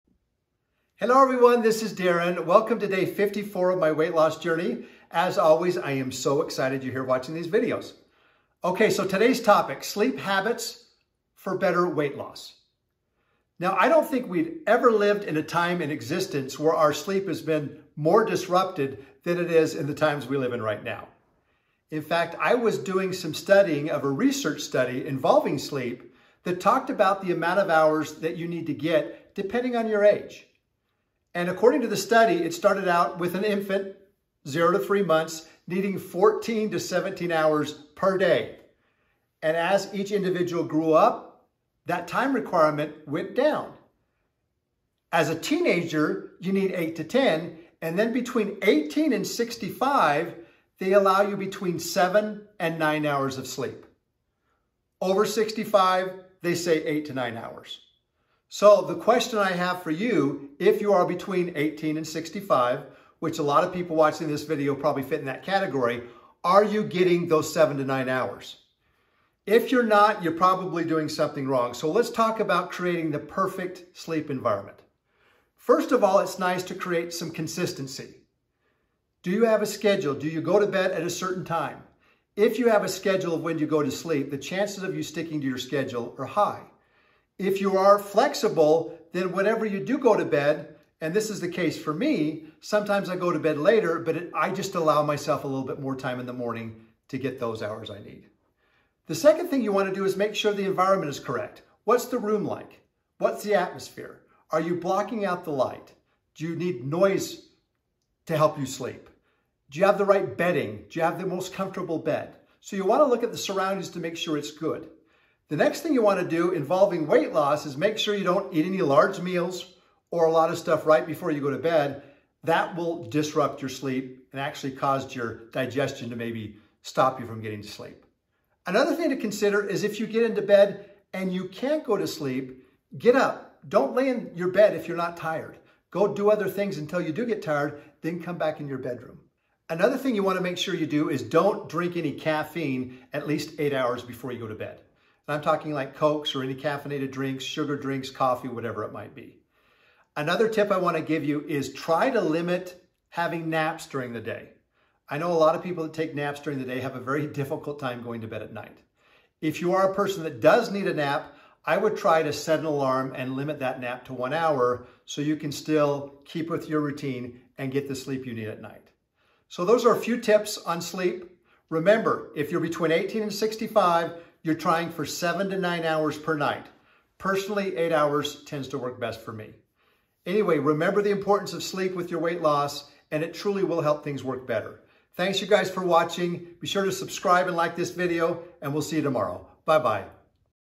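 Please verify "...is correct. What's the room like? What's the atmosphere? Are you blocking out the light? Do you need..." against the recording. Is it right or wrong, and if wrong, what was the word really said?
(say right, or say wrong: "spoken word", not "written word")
right.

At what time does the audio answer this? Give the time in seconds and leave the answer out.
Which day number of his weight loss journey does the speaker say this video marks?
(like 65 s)
2 s.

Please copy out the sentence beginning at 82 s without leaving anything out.
If you have a schedule of when you go to sleep, the chances of you sticking to your schedule are high.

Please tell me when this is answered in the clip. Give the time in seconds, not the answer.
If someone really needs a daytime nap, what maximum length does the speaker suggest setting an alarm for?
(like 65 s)
164 s.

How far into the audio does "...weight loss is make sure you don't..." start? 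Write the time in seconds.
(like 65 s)
117 s.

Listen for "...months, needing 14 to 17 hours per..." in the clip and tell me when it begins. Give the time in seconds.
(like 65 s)
35 s.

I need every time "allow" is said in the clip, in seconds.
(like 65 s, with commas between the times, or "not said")
50 s, 94 s.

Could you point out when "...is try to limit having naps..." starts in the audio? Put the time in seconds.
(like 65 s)
151 s.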